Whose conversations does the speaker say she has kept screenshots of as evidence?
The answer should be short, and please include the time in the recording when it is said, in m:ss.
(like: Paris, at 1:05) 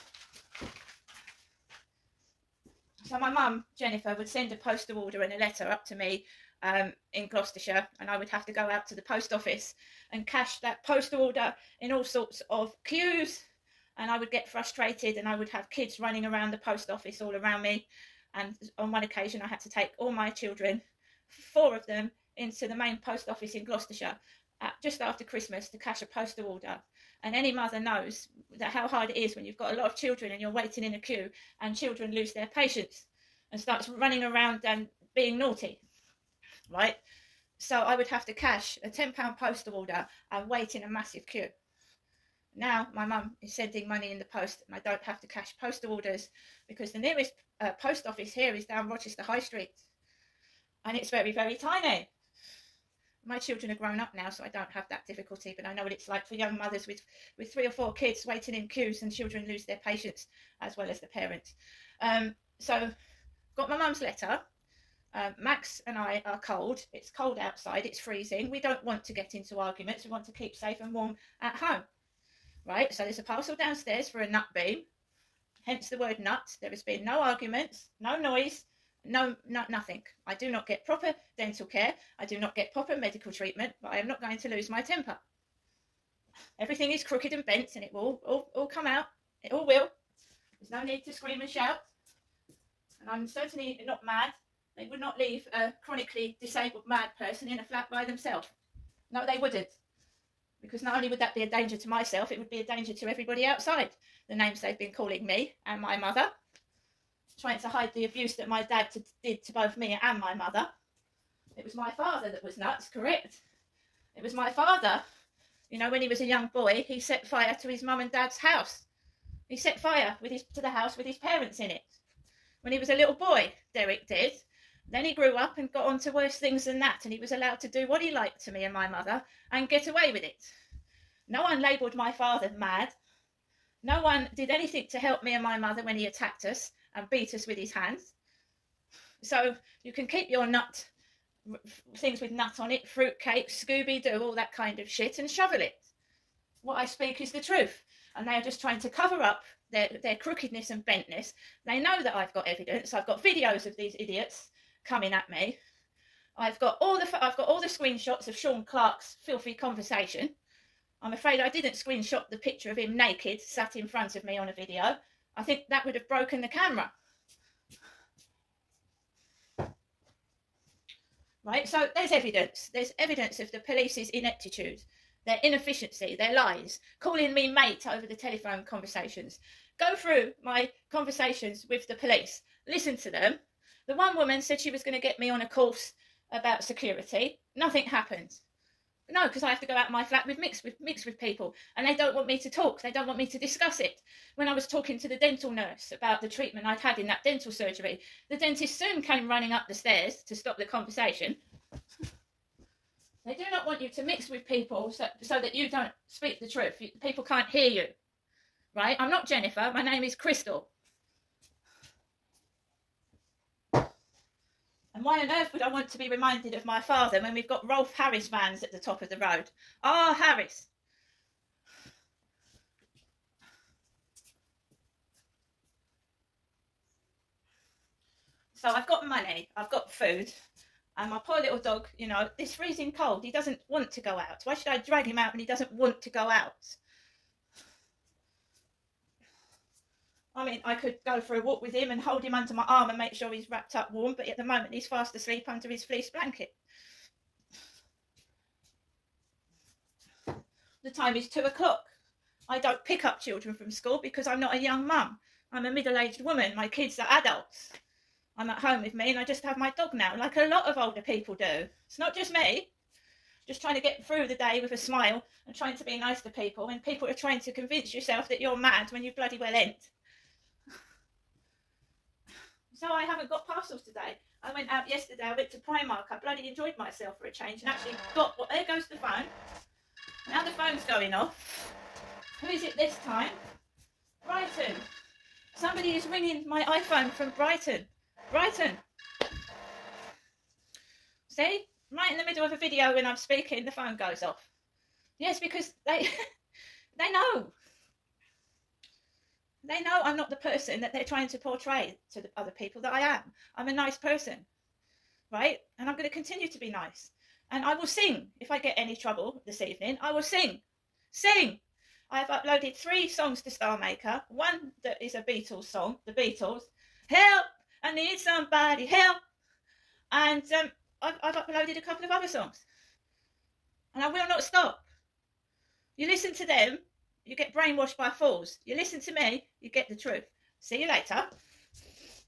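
Sean Clark, at 2:38.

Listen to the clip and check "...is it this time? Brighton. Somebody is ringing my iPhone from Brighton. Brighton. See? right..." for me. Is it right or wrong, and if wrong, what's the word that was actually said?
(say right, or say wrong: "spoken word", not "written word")
right.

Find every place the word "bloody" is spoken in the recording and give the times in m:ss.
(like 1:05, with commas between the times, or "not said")
4:29, 4:36.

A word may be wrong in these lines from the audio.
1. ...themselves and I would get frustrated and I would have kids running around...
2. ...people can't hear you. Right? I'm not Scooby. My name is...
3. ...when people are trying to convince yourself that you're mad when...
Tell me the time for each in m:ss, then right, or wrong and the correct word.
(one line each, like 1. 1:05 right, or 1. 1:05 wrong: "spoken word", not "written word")
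1. 0:12 wrong: "queues", not "themselves"
2. 3:27 wrong: "Jennifer", not "Scooby"
3. 4:26 right.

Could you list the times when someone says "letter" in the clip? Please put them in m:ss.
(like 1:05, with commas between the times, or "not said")
0:05, 1:04.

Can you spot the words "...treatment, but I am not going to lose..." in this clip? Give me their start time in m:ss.
1:23.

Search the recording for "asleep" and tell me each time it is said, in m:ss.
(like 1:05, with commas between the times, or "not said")
4:05.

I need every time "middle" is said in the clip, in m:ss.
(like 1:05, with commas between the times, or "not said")
4:15, 4:52.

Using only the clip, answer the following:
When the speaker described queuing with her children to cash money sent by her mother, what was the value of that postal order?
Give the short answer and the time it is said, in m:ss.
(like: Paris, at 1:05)
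£10, at 0:38.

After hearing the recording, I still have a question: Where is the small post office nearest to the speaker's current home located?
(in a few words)
Rochester High Street.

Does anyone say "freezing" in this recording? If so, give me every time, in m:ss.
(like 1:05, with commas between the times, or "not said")
1:07, 3:52.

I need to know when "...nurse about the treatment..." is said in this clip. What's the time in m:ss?
3:15.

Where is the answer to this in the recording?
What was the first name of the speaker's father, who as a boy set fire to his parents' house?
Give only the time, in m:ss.
2:03.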